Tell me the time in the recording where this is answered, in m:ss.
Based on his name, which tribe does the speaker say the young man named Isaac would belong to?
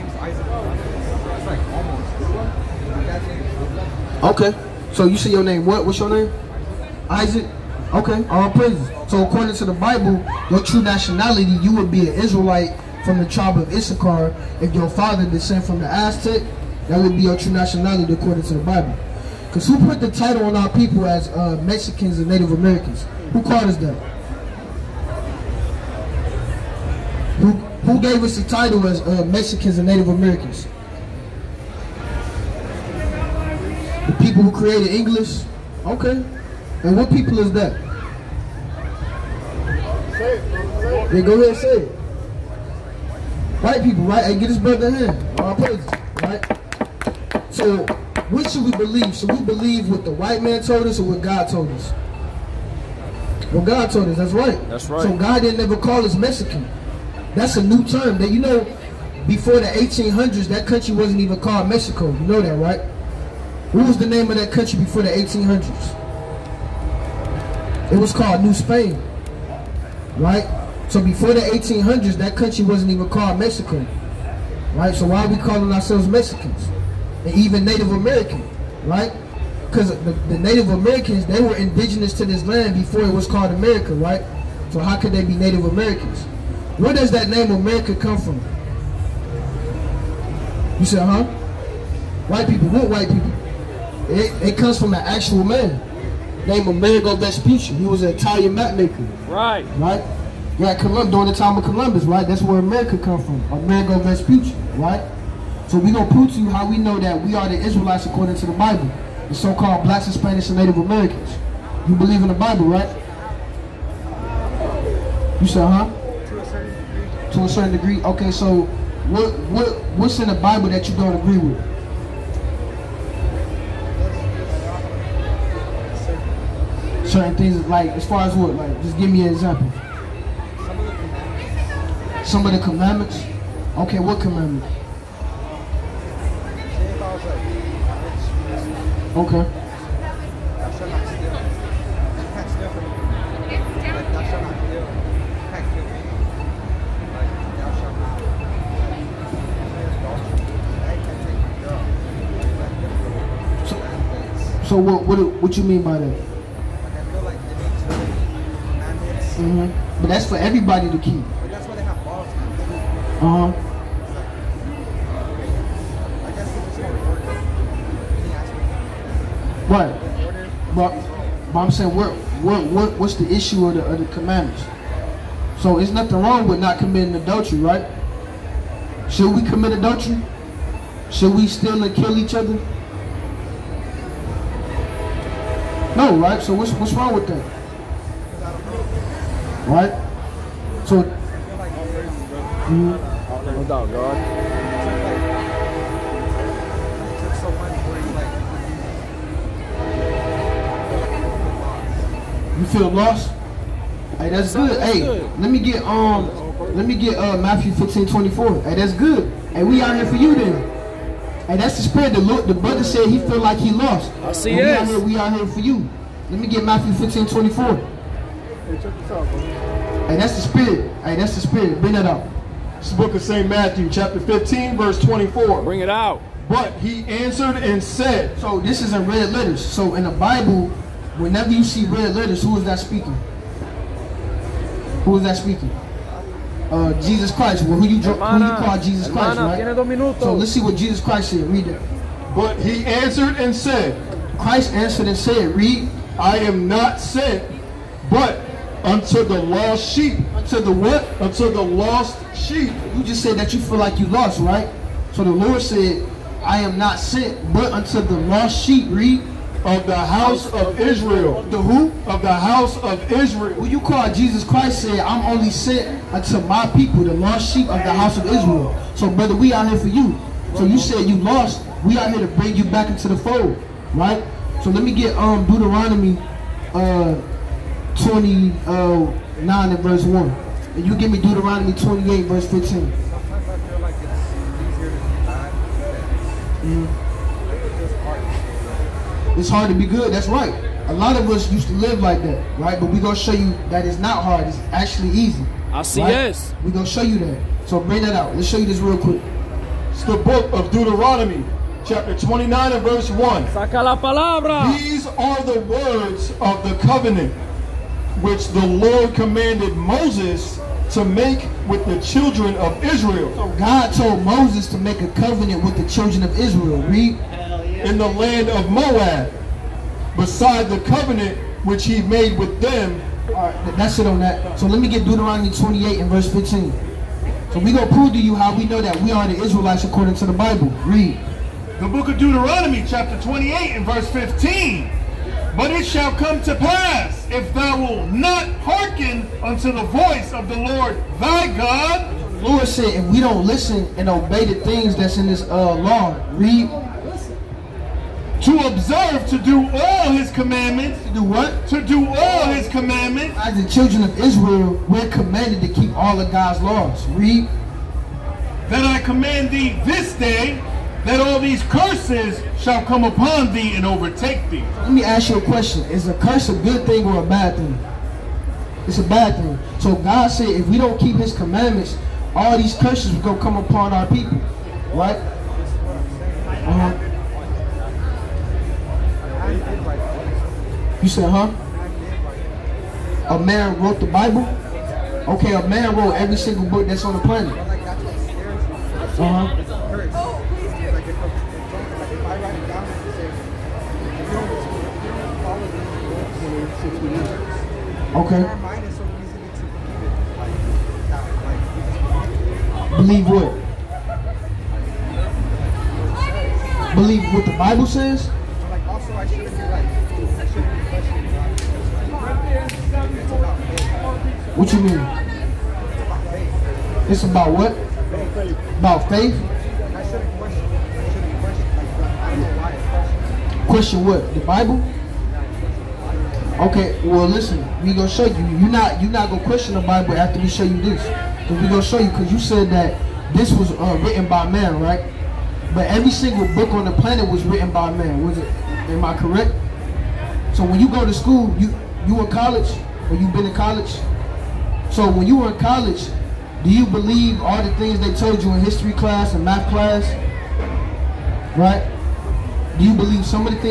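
0:13.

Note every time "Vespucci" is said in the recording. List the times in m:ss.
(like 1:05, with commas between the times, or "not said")
1:37, 1:43.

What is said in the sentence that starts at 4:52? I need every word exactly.
But we're going to show you that it's not hard, it's actually easy.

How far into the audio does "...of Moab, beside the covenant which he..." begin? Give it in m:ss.
5:18.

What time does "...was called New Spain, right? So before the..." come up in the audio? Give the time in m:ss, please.
1:07.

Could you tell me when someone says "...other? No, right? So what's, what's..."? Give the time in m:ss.
3:02.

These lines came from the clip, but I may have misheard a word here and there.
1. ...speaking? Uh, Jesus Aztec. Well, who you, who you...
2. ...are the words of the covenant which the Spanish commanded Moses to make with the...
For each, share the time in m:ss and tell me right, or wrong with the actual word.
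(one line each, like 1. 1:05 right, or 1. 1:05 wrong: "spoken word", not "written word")
1. 3:55 wrong: "Christ", not "Aztec"
2. 5:05 wrong: "Lord", not "Spanish".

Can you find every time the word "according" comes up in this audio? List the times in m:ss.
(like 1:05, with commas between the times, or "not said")
0:09, 0:18, 1:48, 5:29.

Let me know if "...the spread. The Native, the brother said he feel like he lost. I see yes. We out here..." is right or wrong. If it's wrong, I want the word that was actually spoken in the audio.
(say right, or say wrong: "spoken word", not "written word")
wrong: "Lord", not "Native".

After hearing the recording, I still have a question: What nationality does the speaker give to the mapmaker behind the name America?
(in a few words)
Italian.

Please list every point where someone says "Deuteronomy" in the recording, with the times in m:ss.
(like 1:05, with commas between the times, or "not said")
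4:35, 4:41, 5:00, 5:25, 5:32.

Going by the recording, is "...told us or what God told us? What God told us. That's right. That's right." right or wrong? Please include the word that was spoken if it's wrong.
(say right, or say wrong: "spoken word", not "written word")
right.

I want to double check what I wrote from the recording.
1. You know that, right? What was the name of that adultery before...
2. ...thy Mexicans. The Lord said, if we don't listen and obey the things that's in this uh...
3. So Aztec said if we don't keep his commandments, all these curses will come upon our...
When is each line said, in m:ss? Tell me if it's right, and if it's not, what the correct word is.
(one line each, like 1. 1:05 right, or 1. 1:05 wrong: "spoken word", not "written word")
1. 1:02 wrong: "country", not "adultery"
2. 5:41 wrong: "God", not "Mexicans"
3. 6:09 wrong: "God", not "Aztec".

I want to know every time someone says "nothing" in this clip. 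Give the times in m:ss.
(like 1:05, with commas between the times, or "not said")
2:55.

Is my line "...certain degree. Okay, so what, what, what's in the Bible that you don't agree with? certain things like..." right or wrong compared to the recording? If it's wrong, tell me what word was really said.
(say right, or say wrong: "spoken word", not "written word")
right.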